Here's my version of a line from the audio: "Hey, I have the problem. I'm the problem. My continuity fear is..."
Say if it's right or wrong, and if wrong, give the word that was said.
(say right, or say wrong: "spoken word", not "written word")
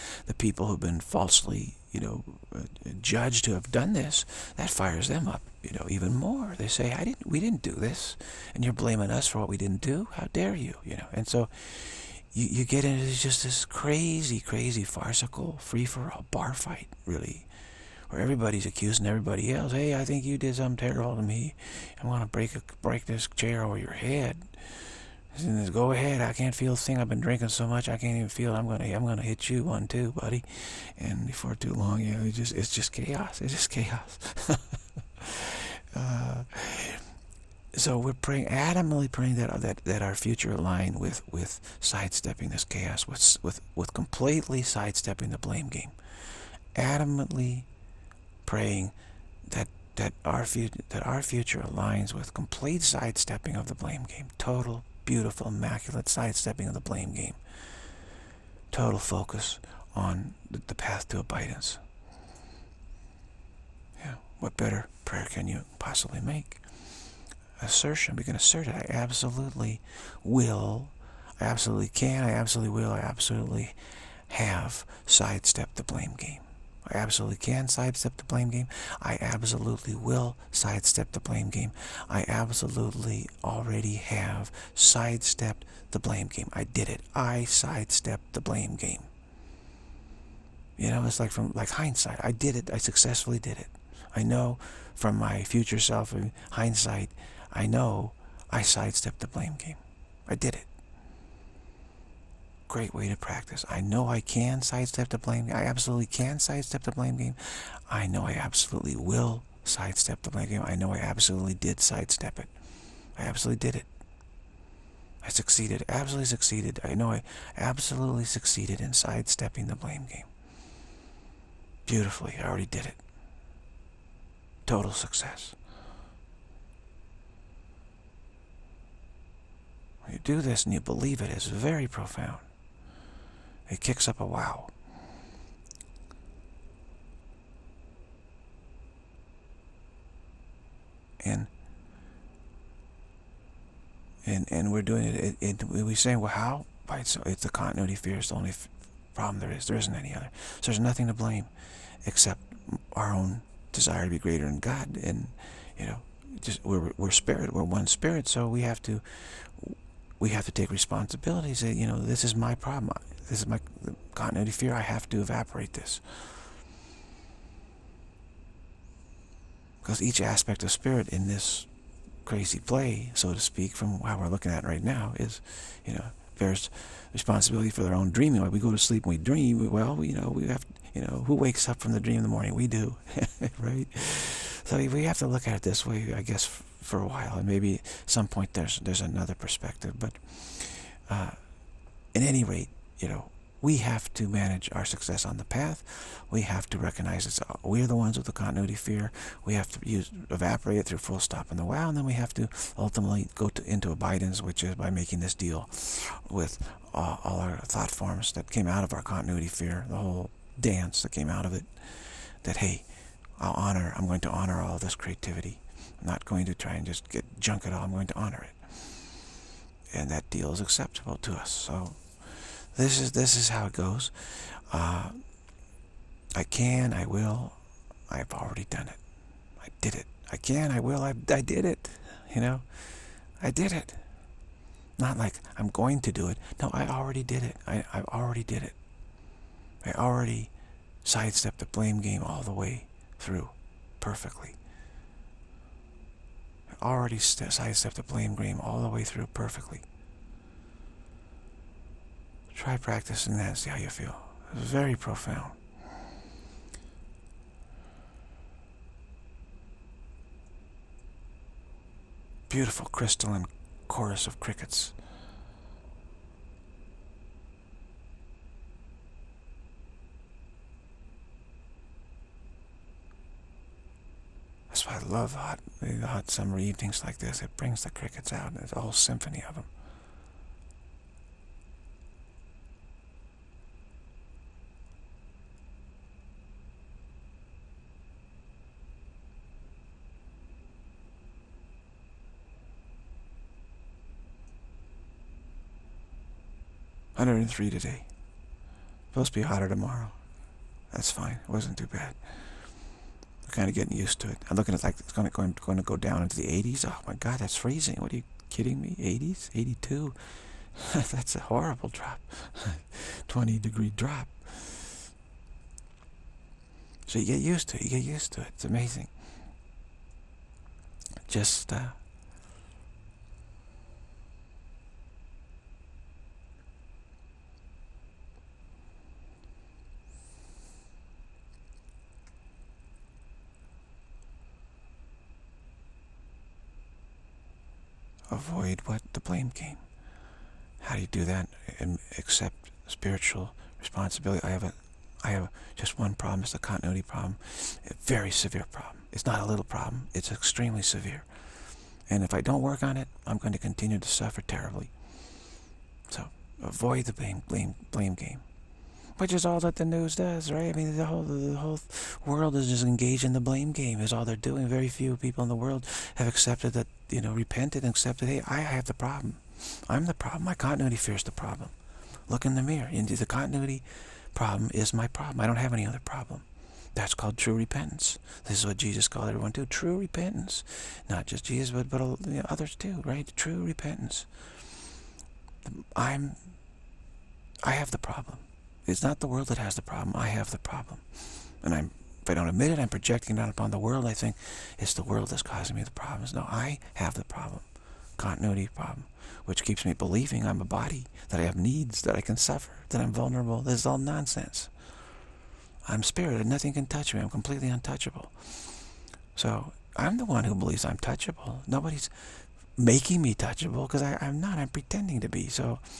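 right.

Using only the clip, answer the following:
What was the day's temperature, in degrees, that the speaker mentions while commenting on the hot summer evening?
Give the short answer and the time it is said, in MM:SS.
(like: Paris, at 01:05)
103, at 04:57.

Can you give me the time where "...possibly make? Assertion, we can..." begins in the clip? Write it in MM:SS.
01:05.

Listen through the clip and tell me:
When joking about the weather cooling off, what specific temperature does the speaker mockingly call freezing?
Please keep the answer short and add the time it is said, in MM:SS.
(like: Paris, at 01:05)
82, at 05:09.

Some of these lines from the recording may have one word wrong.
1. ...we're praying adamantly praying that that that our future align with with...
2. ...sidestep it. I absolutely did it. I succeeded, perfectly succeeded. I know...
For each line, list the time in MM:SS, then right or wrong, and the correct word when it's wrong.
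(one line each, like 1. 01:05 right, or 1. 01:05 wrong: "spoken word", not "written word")
1. 00:37 right
2. 01:51 wrong: "absolutely", not "perfectly".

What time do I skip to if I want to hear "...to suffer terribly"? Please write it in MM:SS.
05:53.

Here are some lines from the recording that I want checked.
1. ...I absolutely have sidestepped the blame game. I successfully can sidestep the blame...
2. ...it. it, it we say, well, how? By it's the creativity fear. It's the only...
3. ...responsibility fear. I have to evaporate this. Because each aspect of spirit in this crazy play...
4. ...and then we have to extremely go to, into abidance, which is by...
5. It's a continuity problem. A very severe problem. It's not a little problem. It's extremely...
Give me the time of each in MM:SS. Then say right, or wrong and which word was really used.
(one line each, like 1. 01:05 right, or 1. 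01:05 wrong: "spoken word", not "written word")
1. 01:12 wrong: "absolutely", not "successfully"
2. 02:25 wrong: "continuity", not "creativity"
3. 02:44 wrong: "continuity", not "responsibility"
4. 03:21 wrong: "ultimately", not "extremely"
5. 05:46 right.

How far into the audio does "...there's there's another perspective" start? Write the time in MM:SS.
03:08.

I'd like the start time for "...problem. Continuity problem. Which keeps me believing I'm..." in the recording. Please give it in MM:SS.
06:37.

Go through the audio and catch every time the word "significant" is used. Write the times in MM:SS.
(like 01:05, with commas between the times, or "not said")
not said.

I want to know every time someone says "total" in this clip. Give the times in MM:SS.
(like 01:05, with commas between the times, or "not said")
00:54, 00:58, 02:04.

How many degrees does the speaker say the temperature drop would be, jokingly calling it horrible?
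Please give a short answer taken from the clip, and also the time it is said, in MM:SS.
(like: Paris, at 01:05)
20, at 05:13.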